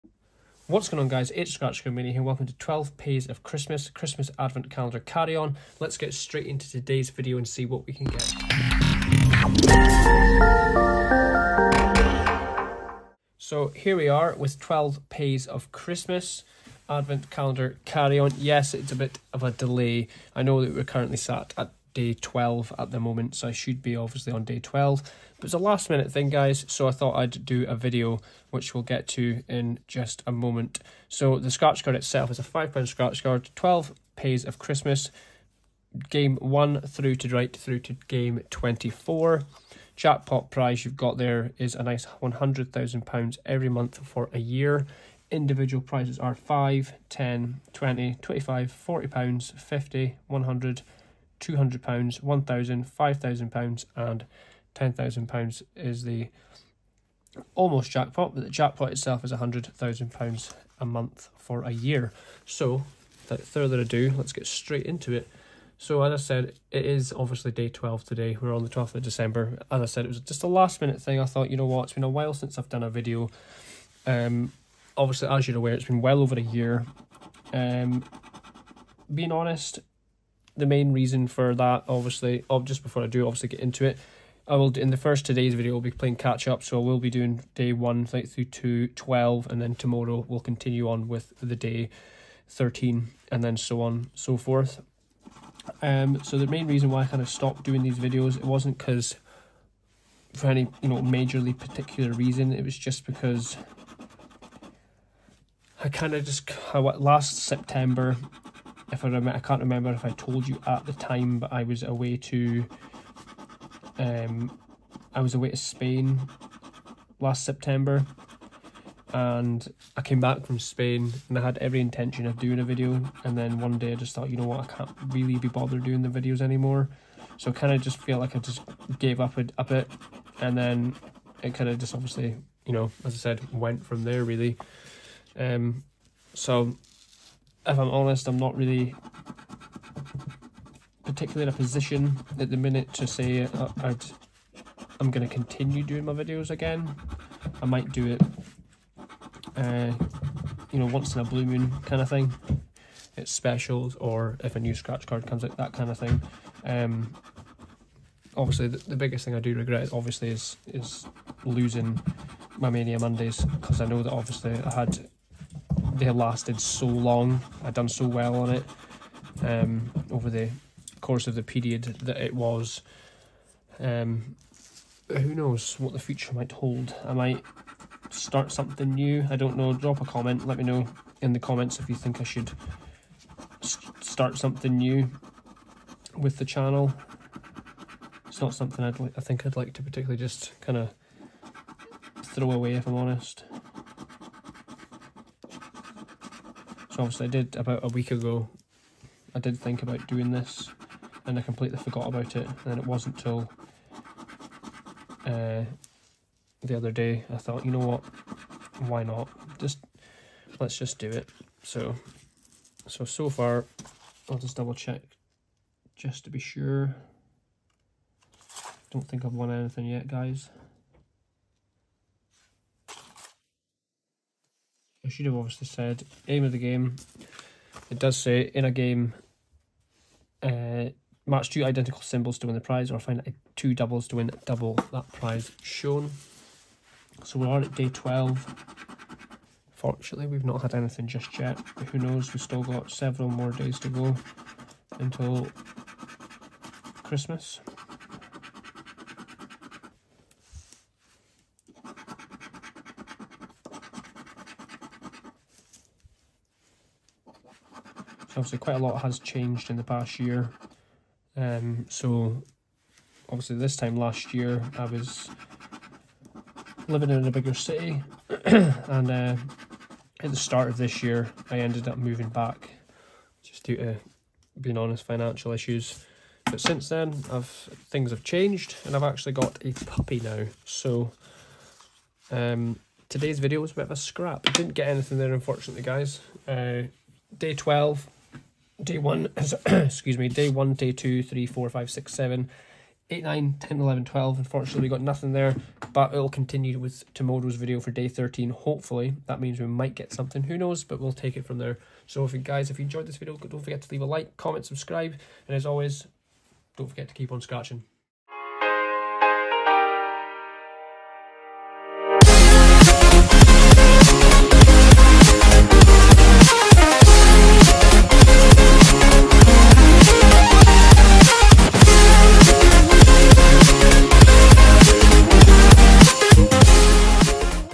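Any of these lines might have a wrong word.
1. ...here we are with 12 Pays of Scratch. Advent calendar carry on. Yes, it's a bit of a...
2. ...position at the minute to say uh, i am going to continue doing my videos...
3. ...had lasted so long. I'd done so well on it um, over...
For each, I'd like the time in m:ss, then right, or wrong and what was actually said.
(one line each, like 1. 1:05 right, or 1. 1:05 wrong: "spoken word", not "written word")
1. 0:13 wrong: "Christmas", not "Scratch"
2. 2:21 right
3. 2:46 right.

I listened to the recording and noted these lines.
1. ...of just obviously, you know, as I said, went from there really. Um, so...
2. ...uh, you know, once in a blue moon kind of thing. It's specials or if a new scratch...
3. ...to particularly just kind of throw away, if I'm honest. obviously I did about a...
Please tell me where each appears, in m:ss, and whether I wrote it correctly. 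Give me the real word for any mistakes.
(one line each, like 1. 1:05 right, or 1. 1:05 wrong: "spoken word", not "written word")
1. 2:11 right
2. 2:29 right
3. 3:09 right.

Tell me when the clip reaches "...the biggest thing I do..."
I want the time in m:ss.
2:38.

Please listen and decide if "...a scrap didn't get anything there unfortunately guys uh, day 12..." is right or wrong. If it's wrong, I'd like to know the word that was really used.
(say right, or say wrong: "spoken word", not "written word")
right.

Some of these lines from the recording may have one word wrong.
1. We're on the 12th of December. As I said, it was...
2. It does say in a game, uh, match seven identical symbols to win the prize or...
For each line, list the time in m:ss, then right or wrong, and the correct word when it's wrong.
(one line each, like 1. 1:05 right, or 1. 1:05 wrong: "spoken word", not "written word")
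1. 1:08 right
2. 3:47 wrong: "two", not "seven".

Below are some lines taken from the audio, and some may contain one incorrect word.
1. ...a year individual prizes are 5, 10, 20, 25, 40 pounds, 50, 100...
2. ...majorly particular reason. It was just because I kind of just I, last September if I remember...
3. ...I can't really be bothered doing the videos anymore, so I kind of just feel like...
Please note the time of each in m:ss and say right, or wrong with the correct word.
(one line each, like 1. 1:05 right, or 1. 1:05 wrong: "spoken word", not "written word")
1. 0:44 right
2. 1:40 right
3. 2:04 right.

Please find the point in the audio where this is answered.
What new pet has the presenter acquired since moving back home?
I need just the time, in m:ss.
4:39.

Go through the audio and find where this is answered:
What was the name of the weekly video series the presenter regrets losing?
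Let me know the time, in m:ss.
2:42.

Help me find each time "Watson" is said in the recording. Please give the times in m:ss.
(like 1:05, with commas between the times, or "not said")
not said.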